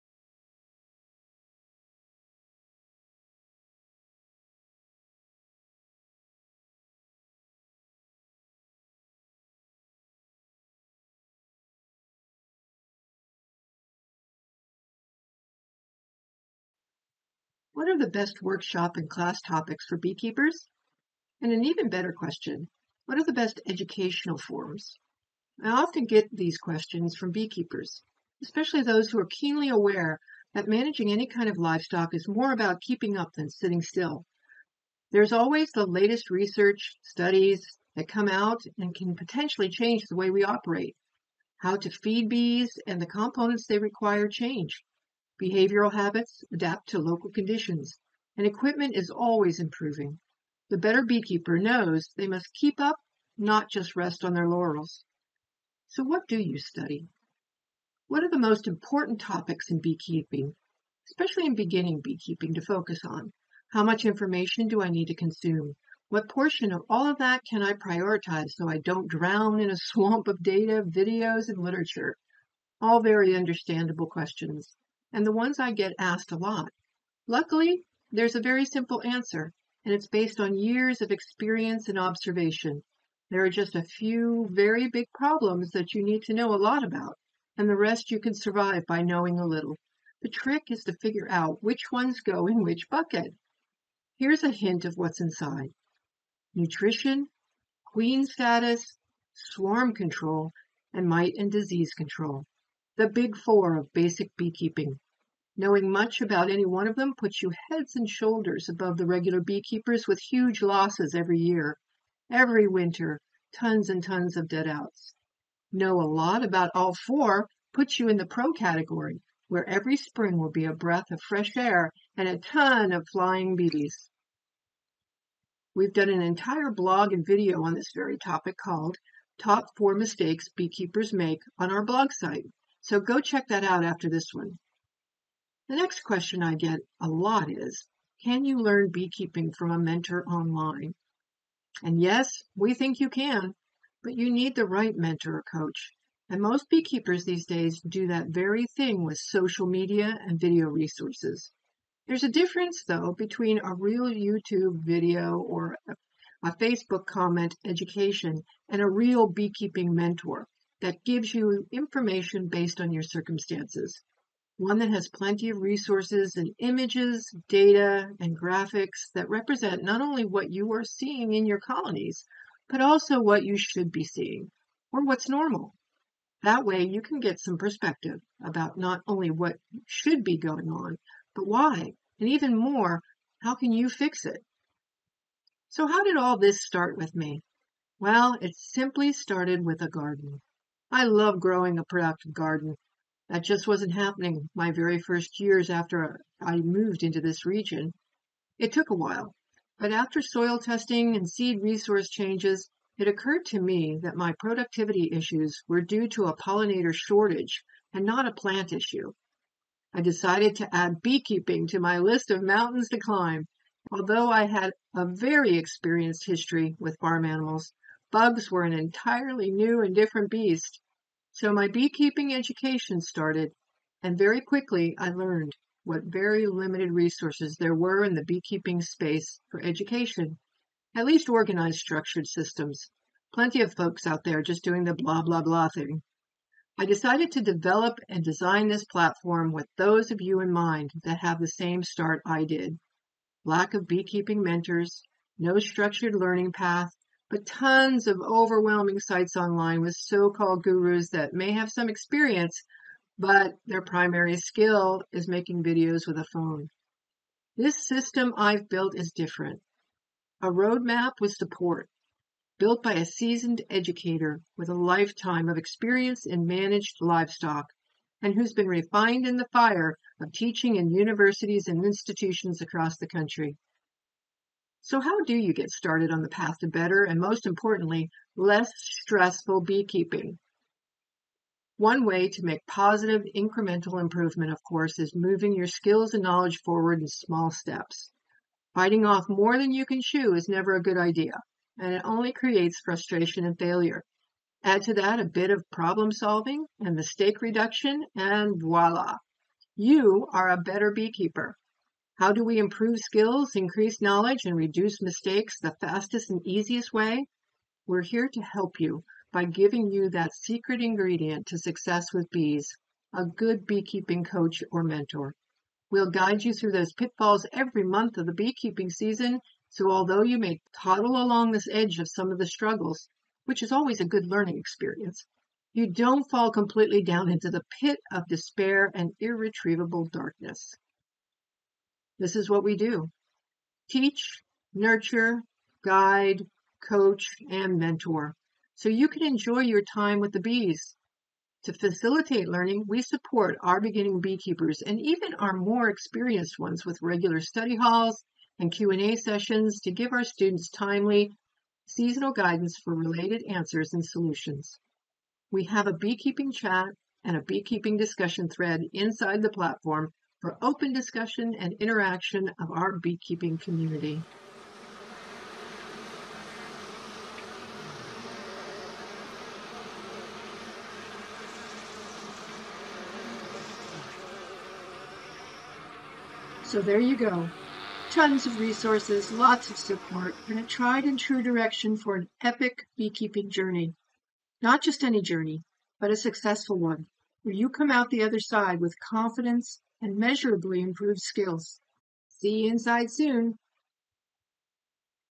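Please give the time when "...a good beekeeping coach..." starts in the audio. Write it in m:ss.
5:13.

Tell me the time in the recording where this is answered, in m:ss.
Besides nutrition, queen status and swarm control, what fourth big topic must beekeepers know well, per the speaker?
1:41.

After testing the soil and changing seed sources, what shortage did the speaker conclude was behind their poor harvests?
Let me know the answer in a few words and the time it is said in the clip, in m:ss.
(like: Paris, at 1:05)
pollinator shortage, at 3:26.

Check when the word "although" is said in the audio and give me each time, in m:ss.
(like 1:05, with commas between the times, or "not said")
3:33, 5:19.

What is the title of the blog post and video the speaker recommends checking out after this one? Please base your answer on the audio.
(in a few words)
Top 4 Mistakes Beekeepers Make.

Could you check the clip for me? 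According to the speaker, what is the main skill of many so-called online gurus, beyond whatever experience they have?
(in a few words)
making videos with a phone.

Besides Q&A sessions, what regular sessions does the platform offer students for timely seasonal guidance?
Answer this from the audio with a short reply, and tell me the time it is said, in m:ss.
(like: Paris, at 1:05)
study halls, at 5:47.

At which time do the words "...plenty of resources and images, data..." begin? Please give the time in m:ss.
2:45.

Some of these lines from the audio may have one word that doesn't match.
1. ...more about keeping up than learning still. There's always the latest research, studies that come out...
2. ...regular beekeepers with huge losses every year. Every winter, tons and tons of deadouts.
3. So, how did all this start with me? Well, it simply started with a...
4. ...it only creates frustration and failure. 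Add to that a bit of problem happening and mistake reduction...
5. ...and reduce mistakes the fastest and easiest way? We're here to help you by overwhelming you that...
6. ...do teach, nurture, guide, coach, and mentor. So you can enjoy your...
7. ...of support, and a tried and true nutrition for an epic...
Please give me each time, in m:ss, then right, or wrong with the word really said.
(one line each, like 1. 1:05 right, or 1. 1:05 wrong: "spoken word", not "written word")
1. 0:32 wrong: "sitting", not "learning"
2. 1:49 right
3. 3:05 right
4. 4:51 wrong: "solving", not "happening"
5. 5:04 wrong: "giving", not "overwhelming"
6. 5:32 right
7. 6:19 wrong: "direction", not "nutrition".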